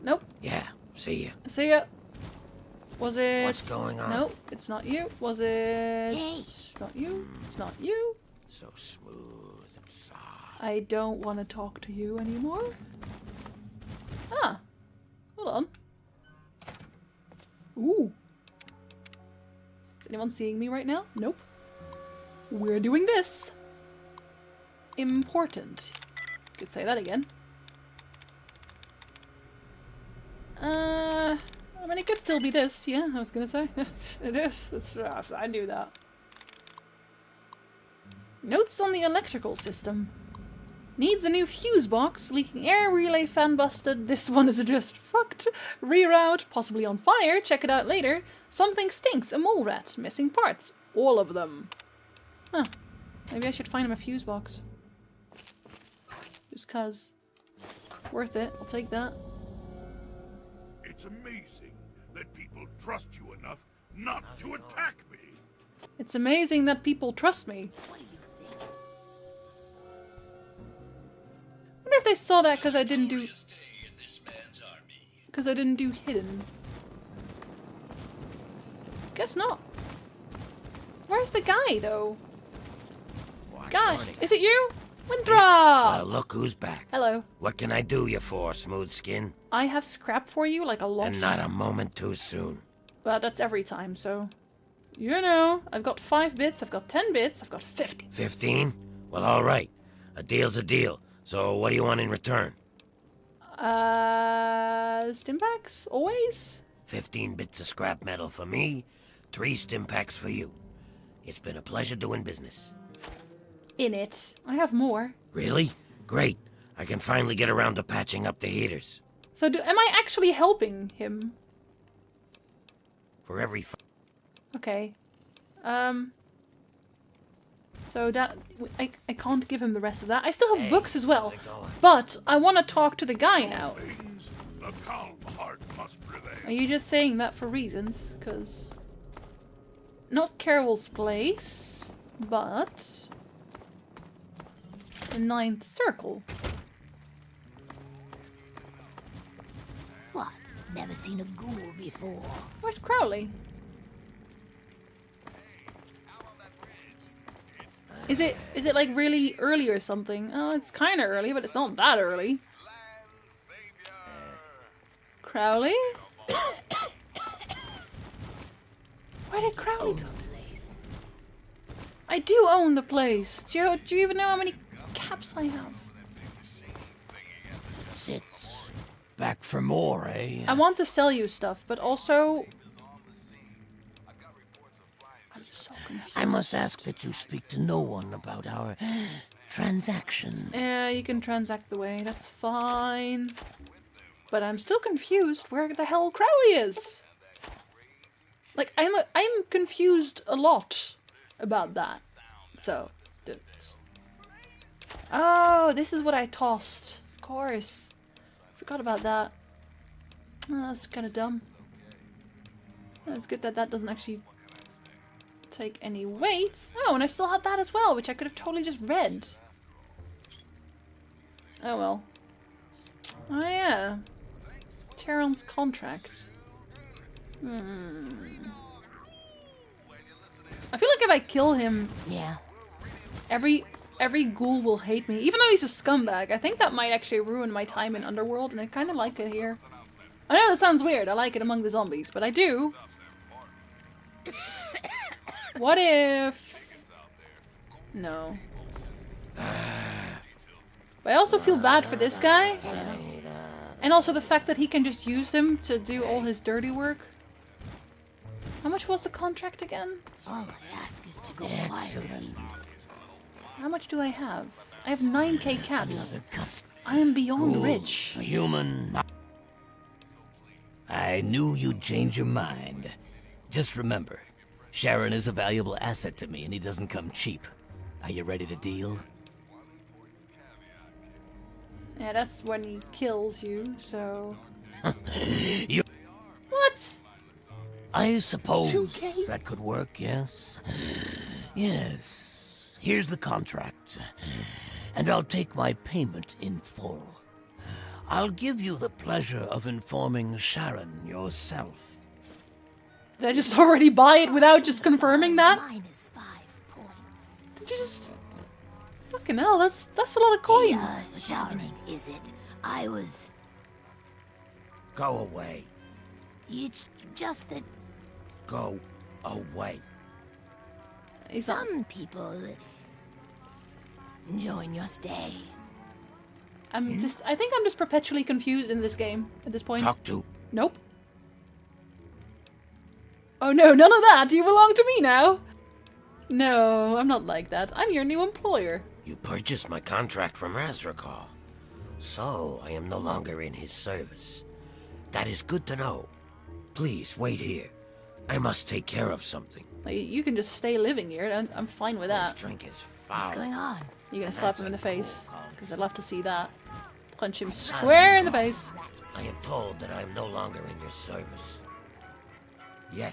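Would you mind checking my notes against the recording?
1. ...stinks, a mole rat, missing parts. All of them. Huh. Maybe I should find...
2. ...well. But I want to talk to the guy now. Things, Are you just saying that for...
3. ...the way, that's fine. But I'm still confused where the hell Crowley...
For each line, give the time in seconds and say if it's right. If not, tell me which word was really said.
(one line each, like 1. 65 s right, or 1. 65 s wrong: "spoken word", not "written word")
1. 48 s right
2. 131 s right
3. 191 s right.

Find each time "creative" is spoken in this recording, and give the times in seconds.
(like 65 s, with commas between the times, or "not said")
not said.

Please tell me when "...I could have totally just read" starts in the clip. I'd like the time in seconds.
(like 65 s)
218 s.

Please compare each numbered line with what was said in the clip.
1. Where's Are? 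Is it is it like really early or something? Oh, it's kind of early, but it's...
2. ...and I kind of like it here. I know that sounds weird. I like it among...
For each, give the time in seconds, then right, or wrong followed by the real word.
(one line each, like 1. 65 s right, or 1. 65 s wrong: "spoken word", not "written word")
1. 152 s wrong: "Crowley", not "Are"
2. 238 s right.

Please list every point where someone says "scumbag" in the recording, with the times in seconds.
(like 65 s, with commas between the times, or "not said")
235 s.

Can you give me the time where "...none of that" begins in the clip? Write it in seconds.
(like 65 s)
333 s.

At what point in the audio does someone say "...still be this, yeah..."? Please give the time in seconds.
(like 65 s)
32 s.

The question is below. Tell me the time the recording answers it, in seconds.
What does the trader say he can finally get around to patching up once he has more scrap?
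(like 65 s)
117 s.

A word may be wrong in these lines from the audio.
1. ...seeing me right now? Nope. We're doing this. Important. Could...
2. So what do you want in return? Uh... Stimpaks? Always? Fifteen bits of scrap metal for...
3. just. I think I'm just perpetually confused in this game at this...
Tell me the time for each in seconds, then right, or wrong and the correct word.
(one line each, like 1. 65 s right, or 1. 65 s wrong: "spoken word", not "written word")
1. 20 s right
2. 101 s right
3. 326 s right.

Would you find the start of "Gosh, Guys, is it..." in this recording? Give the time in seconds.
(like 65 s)
83 s.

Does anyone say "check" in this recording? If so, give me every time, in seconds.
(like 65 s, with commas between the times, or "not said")
47 s.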